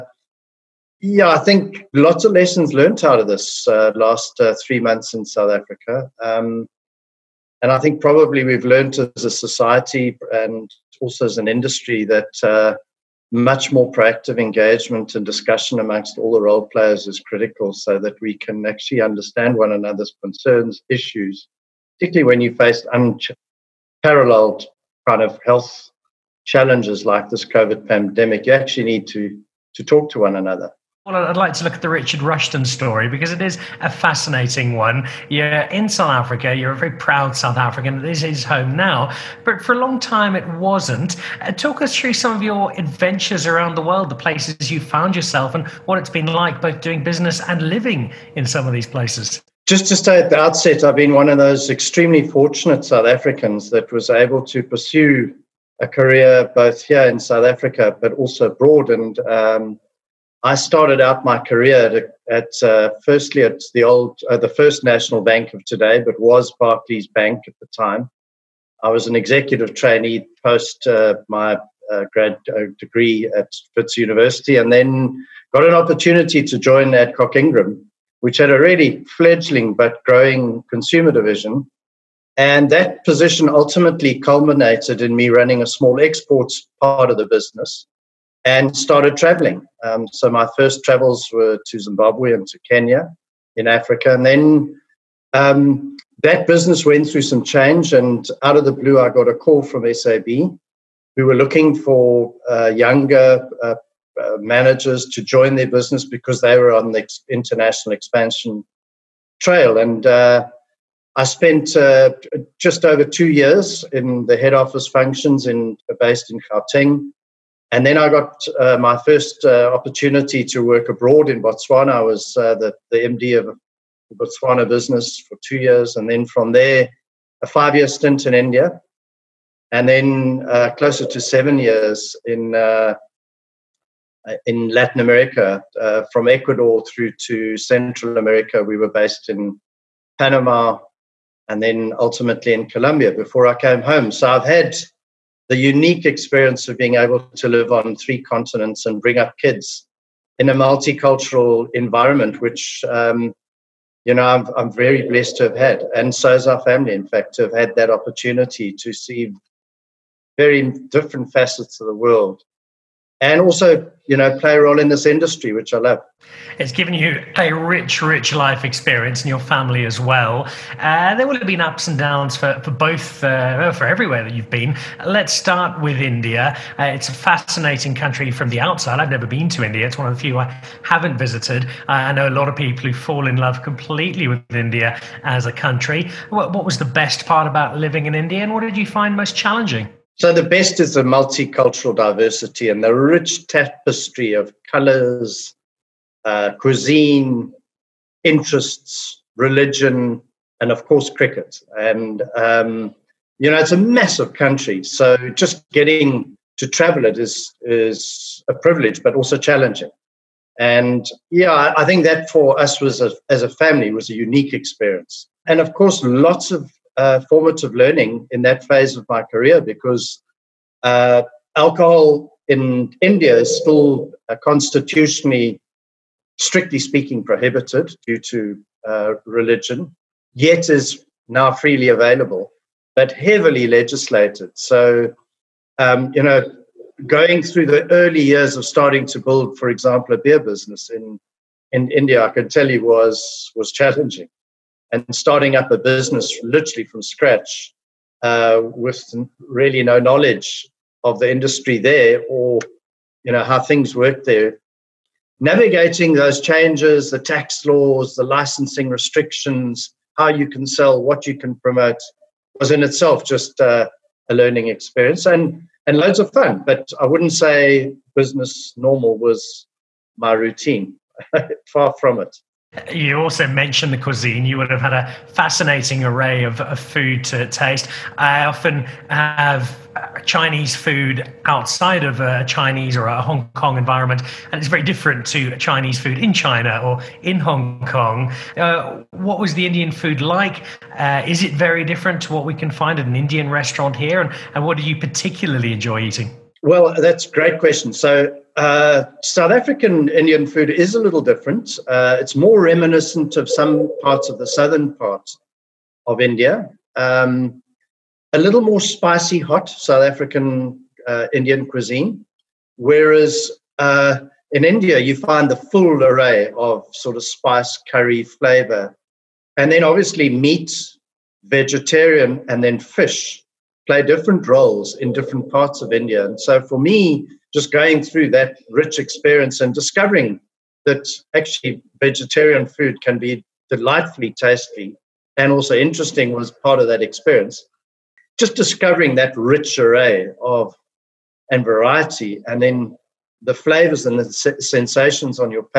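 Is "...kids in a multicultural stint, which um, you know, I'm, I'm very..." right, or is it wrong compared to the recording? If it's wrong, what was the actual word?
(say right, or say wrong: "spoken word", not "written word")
wrong: "environment", not "stint".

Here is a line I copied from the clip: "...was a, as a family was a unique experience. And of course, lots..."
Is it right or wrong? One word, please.
right.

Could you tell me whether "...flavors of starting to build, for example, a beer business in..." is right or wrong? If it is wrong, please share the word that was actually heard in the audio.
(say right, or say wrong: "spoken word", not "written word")
wrong: "years", not "flavors".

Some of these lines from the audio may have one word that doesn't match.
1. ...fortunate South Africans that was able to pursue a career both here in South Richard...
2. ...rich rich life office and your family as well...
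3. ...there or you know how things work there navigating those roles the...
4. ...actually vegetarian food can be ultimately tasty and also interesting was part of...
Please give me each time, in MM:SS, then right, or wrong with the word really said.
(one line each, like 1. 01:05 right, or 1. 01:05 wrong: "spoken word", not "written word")
1. 00:52 wrong: "Africa", not "Richard"
2. 02:47 wrong: "experience", not "office"
3. 04:11 wrong: "changes", not "roles"
4. 05:31 wrong: "delightfully", not "ultimately".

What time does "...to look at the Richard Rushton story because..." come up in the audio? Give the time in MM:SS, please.
00:31.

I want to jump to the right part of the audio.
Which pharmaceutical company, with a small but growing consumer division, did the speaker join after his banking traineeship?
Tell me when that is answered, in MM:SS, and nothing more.
01:16.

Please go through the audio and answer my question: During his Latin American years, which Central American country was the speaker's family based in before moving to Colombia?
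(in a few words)
Panama.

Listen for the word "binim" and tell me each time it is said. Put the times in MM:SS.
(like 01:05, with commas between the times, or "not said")
not said.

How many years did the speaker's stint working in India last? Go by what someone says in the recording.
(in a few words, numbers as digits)
5.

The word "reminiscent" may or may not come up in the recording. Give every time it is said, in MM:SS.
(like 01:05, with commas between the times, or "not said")
05:02.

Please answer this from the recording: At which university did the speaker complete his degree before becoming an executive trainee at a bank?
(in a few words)
Wits University.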